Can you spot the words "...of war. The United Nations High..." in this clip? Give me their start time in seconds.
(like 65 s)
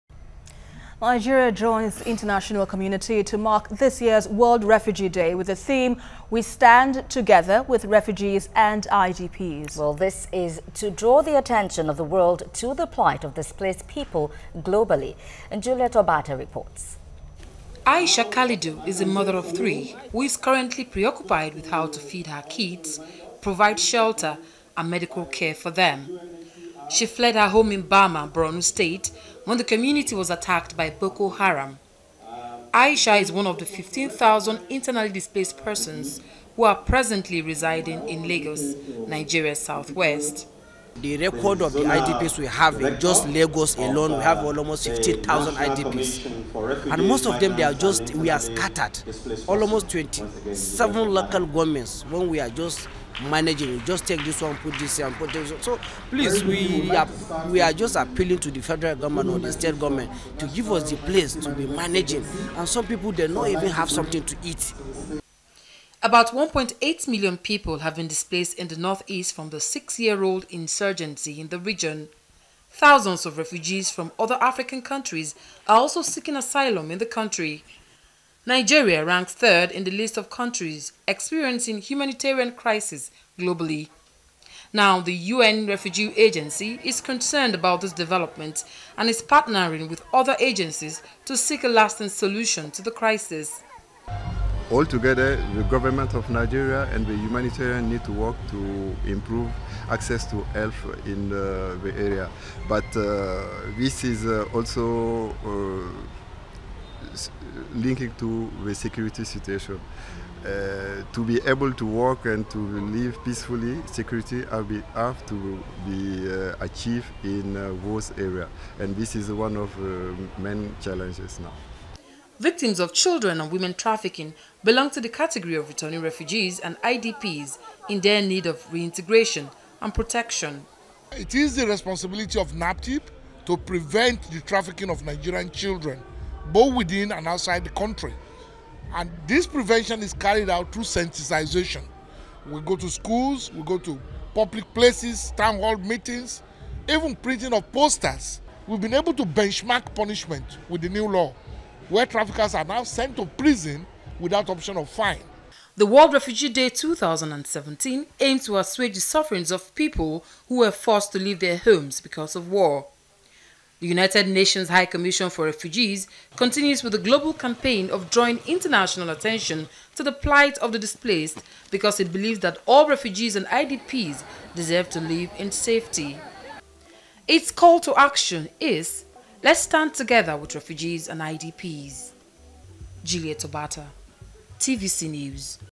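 162 s.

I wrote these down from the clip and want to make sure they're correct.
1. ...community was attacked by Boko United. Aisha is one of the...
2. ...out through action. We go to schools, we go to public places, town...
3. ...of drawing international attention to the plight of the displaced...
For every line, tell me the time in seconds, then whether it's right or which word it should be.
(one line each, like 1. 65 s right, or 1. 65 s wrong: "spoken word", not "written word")
1. 29 s wrong: "Haram", not "United"
2. 140 s wrong: "sensitization", not "action"
3. 167 s right.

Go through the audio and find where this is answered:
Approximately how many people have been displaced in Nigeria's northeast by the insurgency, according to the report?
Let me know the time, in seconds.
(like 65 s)
66 s.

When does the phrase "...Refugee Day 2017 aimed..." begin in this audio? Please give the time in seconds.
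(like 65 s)
156 s.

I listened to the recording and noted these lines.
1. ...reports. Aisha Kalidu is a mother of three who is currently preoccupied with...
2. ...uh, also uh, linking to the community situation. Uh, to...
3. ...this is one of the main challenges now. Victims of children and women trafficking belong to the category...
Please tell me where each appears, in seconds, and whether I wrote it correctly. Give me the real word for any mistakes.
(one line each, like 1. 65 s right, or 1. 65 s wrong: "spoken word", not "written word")
1. 16 s right
2. 104 s wrong: "security", not "community"
3. 118 s right.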